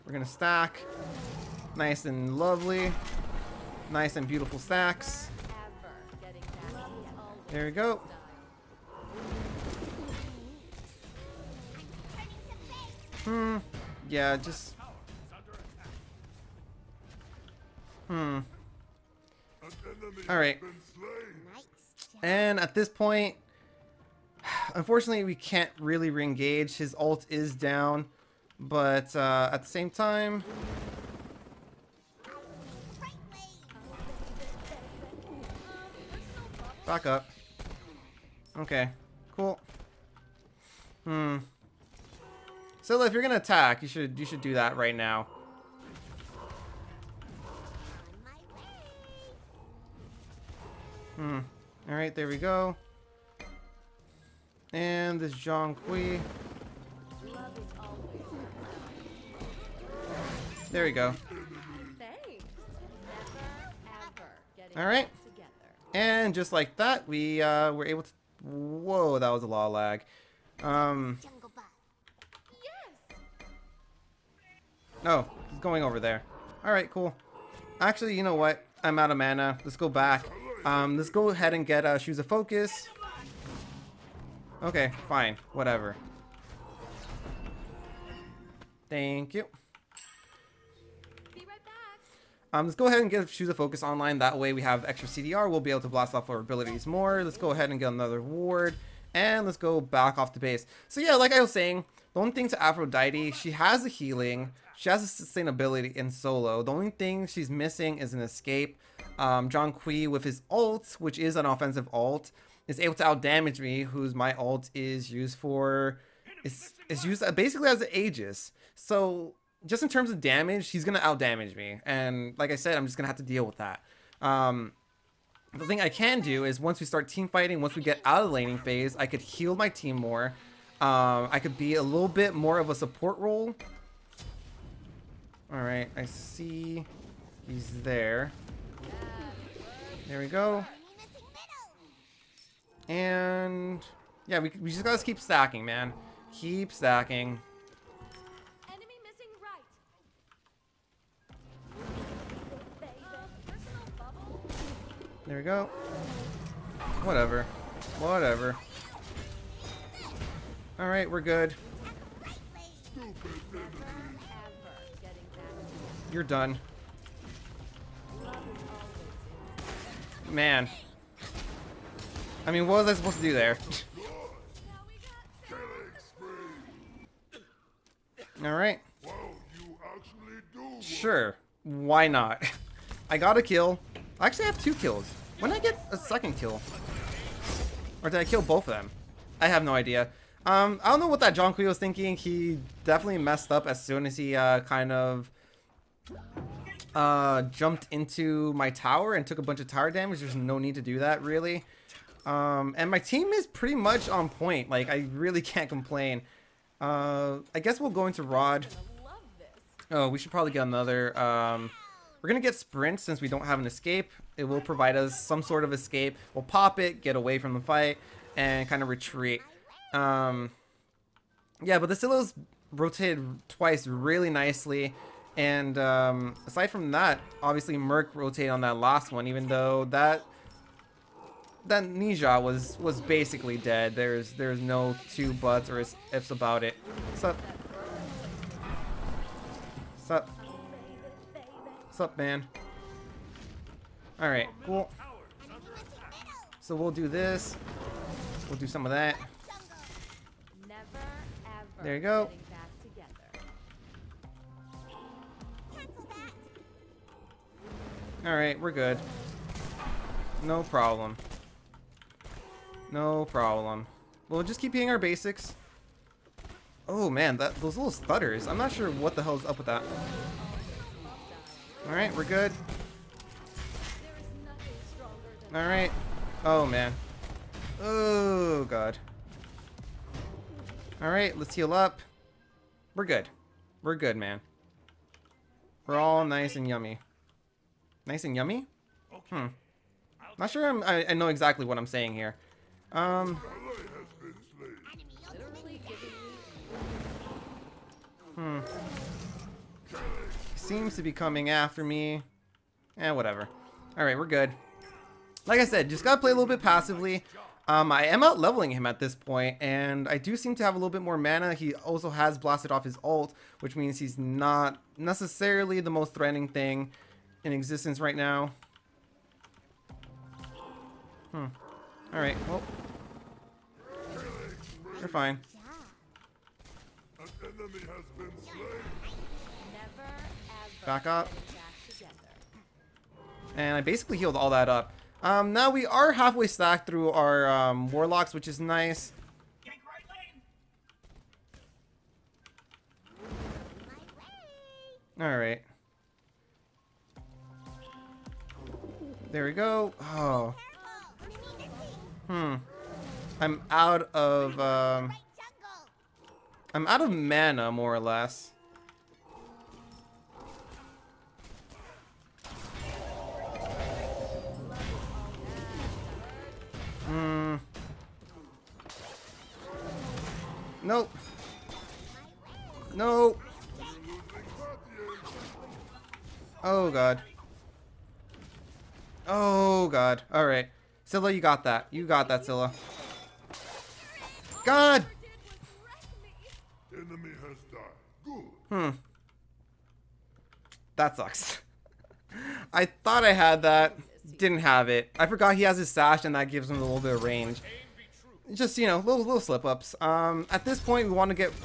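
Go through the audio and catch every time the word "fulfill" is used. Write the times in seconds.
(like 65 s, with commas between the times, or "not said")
not said.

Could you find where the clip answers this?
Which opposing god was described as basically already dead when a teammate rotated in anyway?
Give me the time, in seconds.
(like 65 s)
231 s.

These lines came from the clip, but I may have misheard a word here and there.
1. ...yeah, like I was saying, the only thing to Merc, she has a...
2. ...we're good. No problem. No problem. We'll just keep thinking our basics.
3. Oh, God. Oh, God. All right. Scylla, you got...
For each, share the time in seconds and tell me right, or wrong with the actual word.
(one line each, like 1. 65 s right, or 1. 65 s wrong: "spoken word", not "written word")
1. 100 s wrong: "Aphrodite", not "Merc"
2. 258 s wrong: "hitting", not "thinking"
3. 376 s right.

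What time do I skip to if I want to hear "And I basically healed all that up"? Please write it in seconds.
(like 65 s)
333 s.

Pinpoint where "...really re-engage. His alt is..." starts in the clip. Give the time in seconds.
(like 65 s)
25 s.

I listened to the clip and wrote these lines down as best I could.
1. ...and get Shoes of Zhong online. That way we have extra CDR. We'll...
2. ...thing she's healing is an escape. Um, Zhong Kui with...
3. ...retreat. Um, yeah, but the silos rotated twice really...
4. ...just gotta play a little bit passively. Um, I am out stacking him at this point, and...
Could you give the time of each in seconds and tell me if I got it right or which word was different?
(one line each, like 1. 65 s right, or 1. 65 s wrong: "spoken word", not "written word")
1. 93 s wrong: "Focus", not "Zhong"
2. 106 s wrong: "missing", not "healing"
3. 218 s right
4. 305 s wrong: "leveling", not "stacking".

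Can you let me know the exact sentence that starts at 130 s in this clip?
Um, I could be a little bit more of a support role.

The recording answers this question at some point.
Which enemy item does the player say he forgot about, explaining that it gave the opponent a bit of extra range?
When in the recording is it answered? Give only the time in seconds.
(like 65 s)
395 s.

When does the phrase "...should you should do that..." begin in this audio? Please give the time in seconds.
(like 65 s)
43 s.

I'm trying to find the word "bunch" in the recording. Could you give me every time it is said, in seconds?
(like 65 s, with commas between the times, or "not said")
199 s.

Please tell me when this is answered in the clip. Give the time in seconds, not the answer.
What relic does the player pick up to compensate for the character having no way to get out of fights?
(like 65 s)
212 s.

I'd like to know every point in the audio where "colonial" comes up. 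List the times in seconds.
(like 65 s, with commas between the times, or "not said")
not said.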